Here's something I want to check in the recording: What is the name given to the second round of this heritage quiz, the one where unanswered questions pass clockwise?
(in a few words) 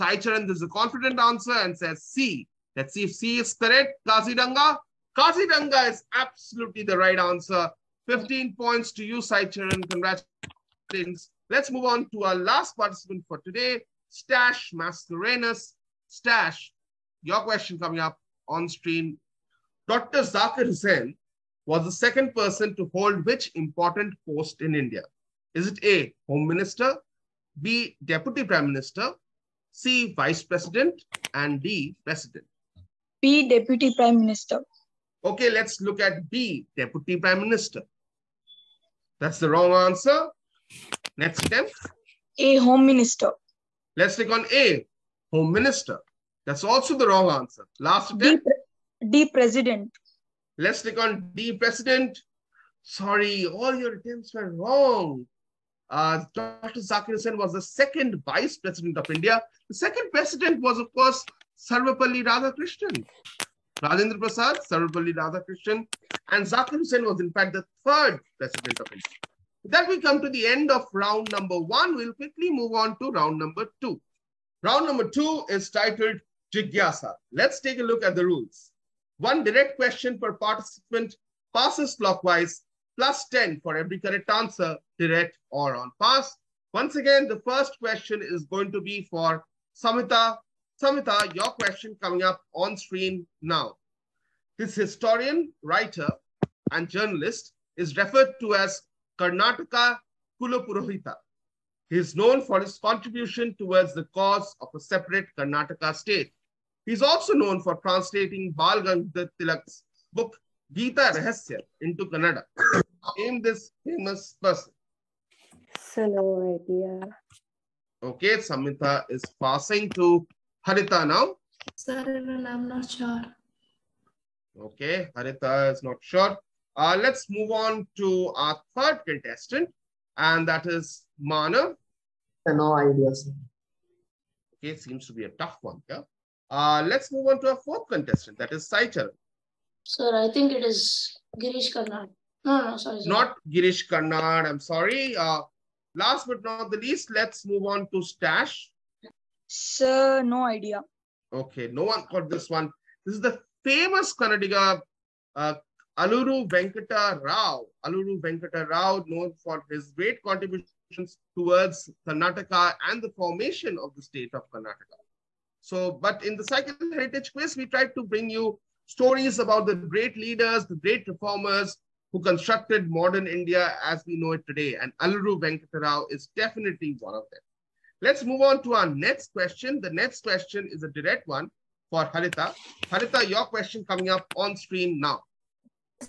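Jigyasa.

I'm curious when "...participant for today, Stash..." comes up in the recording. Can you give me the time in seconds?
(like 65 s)
12 s.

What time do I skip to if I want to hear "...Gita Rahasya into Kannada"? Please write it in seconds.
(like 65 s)
110 s.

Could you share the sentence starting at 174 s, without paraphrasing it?
And Aluru Venkata Rao is definitely one of them.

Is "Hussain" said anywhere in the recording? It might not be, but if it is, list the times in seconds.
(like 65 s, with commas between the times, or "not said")
20 s, 57 s, 66 s.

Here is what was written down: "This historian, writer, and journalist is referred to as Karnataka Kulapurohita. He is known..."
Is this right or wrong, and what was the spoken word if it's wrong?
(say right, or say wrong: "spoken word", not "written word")
right.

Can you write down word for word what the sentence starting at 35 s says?
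Okay, let's look at B, Deputy Prime Minister.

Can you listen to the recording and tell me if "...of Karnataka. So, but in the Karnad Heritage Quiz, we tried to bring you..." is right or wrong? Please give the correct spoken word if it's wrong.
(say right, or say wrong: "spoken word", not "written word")
wrong: "Cycle", not "Karnad".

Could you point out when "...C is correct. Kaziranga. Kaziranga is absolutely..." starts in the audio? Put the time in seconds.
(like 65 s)
3 s.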